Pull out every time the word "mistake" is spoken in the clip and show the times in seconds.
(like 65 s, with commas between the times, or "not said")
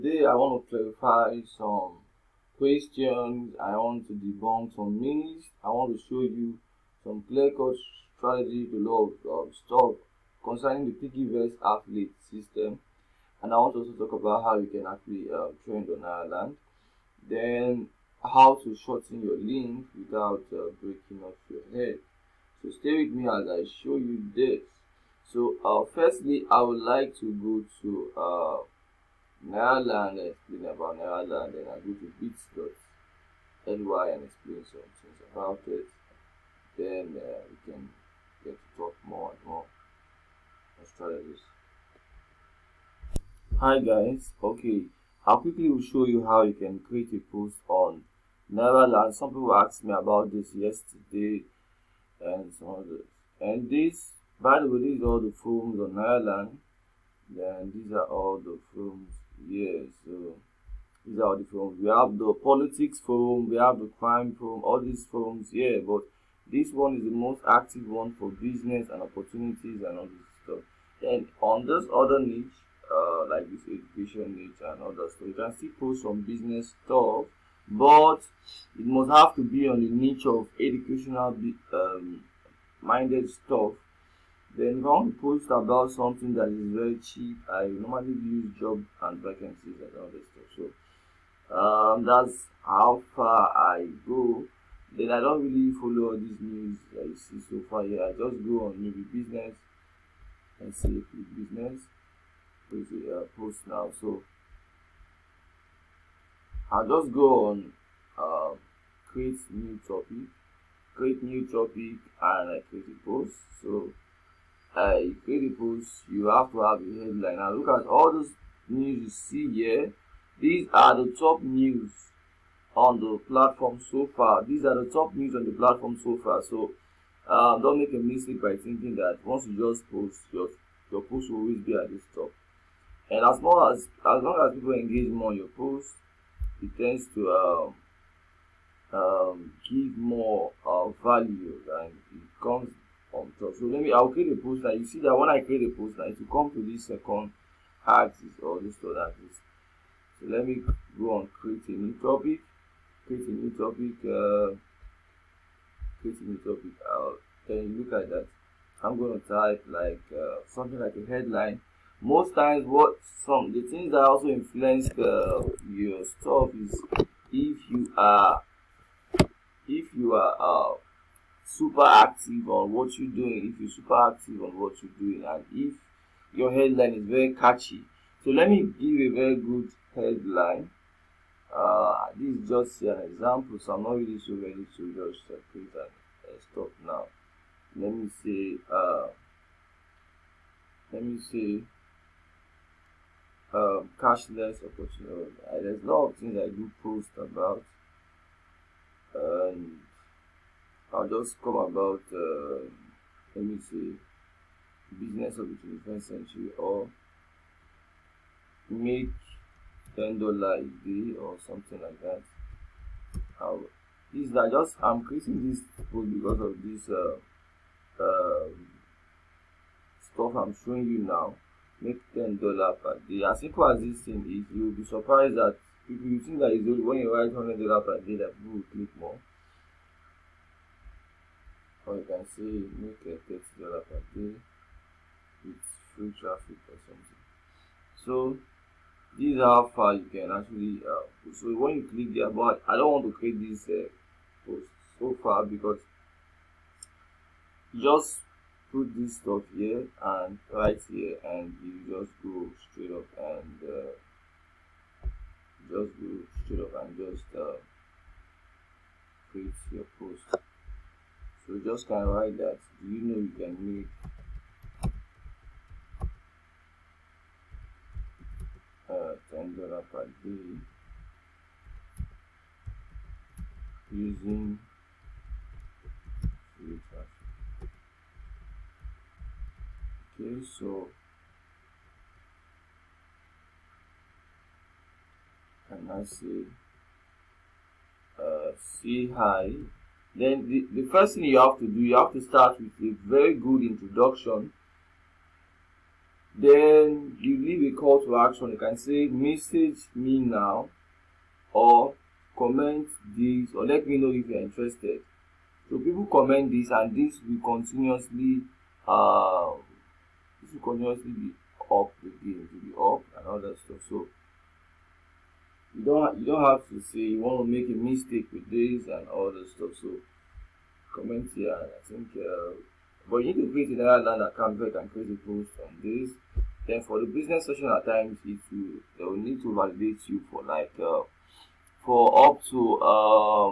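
127 s, 317 s.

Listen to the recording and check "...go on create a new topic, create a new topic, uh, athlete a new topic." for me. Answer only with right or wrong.
wrong.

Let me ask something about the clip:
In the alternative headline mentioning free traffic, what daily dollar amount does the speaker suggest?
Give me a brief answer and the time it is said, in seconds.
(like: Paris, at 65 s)
$30, at 233 s.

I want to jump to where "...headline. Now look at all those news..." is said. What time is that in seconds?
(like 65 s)
116 s.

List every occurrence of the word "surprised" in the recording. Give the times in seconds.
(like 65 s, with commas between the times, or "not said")
224 s.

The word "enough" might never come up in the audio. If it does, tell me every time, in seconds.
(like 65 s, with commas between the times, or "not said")
not said.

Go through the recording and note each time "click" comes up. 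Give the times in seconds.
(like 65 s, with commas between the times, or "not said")
228 s, 241 s.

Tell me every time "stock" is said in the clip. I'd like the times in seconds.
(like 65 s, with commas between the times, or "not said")
9 s.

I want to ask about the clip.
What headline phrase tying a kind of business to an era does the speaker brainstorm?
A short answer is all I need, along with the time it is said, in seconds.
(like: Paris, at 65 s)
Business of the 21st century, at 204 s.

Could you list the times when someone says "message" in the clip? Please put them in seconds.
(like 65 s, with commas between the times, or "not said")
299 s.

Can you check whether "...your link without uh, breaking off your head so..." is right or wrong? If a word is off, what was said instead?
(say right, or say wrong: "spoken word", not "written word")
right.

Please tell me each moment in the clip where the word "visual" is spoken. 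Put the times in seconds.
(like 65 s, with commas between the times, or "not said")
not said.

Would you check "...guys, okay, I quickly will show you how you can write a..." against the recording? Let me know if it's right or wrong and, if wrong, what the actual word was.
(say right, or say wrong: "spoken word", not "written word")
wrong: "create", not "write".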